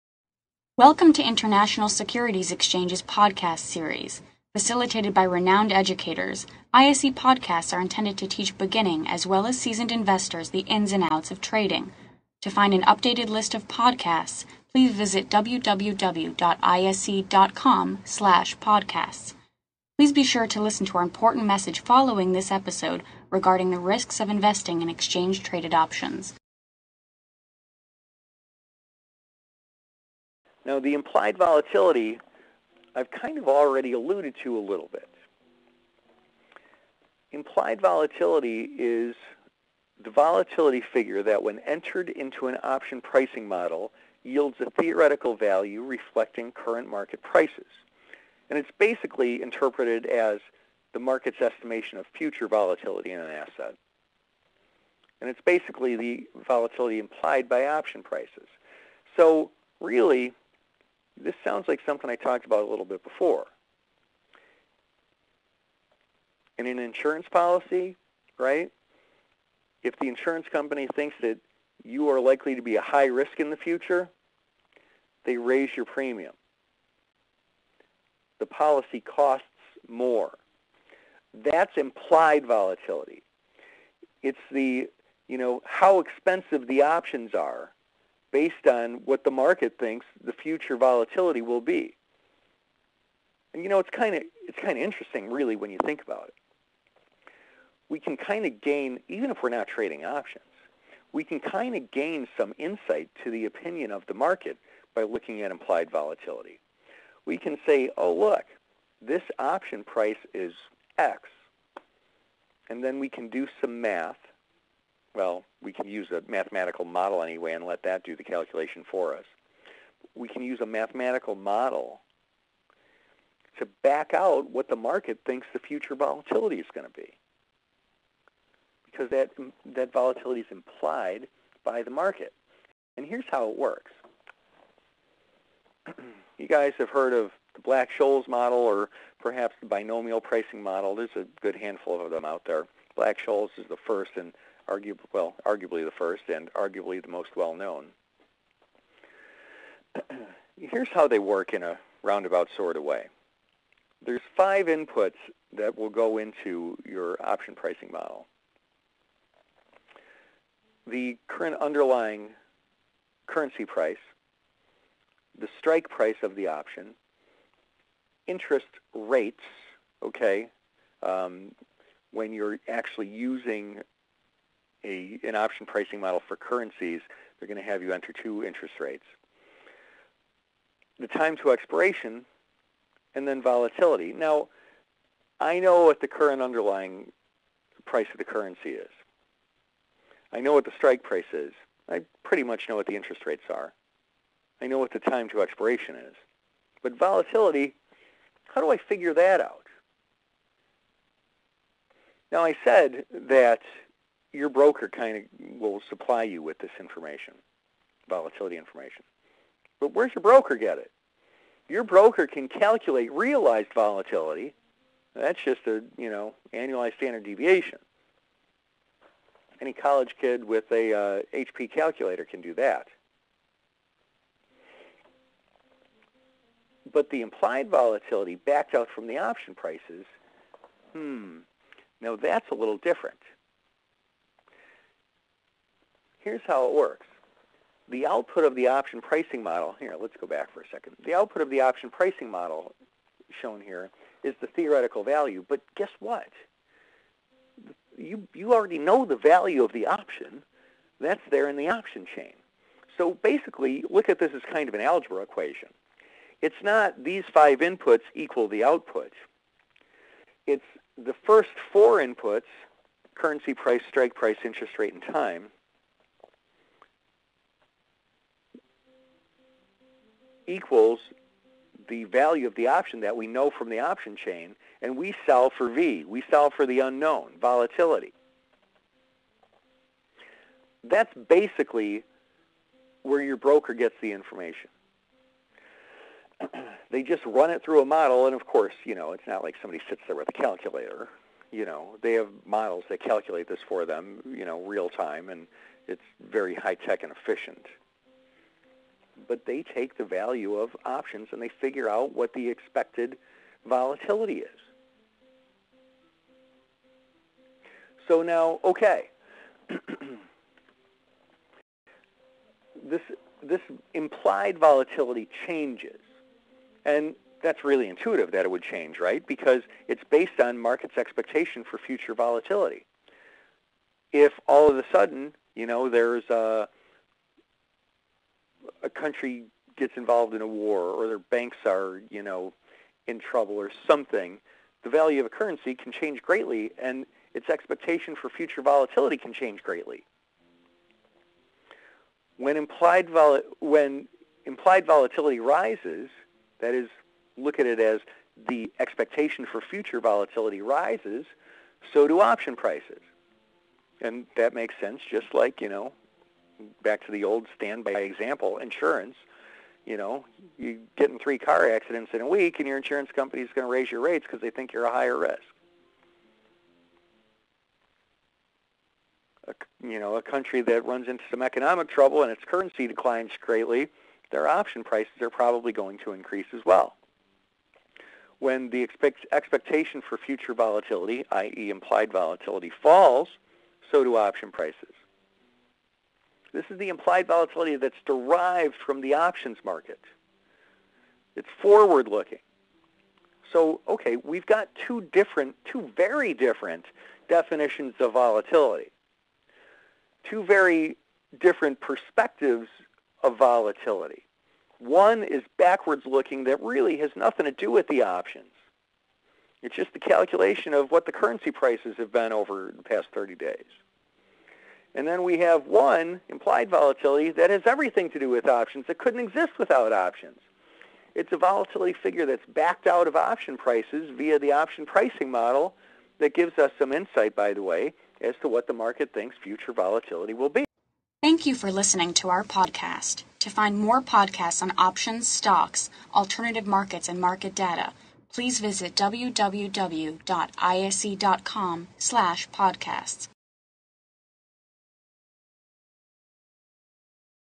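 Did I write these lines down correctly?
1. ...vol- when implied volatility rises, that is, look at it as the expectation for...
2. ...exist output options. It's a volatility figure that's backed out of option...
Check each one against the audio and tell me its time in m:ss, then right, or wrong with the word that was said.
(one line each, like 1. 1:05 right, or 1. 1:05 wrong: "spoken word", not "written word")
1. 5:43 right
2. 6:59 wrong: "without", not "output".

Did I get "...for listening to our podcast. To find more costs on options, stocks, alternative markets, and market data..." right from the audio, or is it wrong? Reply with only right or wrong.
wrong.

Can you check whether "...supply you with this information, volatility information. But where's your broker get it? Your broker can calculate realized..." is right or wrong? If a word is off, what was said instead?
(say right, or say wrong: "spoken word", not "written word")
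right.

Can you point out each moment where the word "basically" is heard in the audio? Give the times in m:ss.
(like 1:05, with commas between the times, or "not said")
0:48, 0:55, 4:13, 4:41.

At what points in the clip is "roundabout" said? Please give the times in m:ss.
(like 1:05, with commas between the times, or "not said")
2:32.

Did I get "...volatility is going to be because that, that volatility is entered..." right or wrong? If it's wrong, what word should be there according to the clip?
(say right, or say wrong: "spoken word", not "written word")
wrong: "implied", not "entered".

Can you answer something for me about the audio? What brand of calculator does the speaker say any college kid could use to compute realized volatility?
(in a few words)
HP.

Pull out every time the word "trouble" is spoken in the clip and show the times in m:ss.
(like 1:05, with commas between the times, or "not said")
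5:33, 6:11.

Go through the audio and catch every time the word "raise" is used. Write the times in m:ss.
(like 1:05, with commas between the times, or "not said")
1:15, 6:03.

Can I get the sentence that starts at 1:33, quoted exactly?
And you know, it's kind of it's kind of interesting, really, when you think about it.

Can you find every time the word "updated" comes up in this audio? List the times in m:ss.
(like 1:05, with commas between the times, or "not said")
0:12.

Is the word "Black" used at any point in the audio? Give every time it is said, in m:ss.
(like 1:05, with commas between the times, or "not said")
2:17, 2:22.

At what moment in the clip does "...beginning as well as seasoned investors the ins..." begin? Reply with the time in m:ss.
0:08.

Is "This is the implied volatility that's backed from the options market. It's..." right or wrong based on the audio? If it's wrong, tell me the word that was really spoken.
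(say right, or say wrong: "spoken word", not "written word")
wrong: "derived", not "backed".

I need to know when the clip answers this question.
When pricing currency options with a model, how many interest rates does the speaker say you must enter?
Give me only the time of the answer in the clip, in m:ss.
2:58.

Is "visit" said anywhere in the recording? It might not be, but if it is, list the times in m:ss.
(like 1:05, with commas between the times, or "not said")
0:14, 7:18.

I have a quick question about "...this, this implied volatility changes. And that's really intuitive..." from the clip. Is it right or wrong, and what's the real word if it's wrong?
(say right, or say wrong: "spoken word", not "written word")
right.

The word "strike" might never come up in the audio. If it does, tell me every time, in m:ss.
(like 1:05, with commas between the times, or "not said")
2:45, 3:10, 4:23.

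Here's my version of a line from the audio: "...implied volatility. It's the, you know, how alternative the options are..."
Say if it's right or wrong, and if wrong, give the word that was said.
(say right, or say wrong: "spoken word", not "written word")
wrong: "expensive", not "alternative".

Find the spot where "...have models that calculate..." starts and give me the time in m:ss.
4:52.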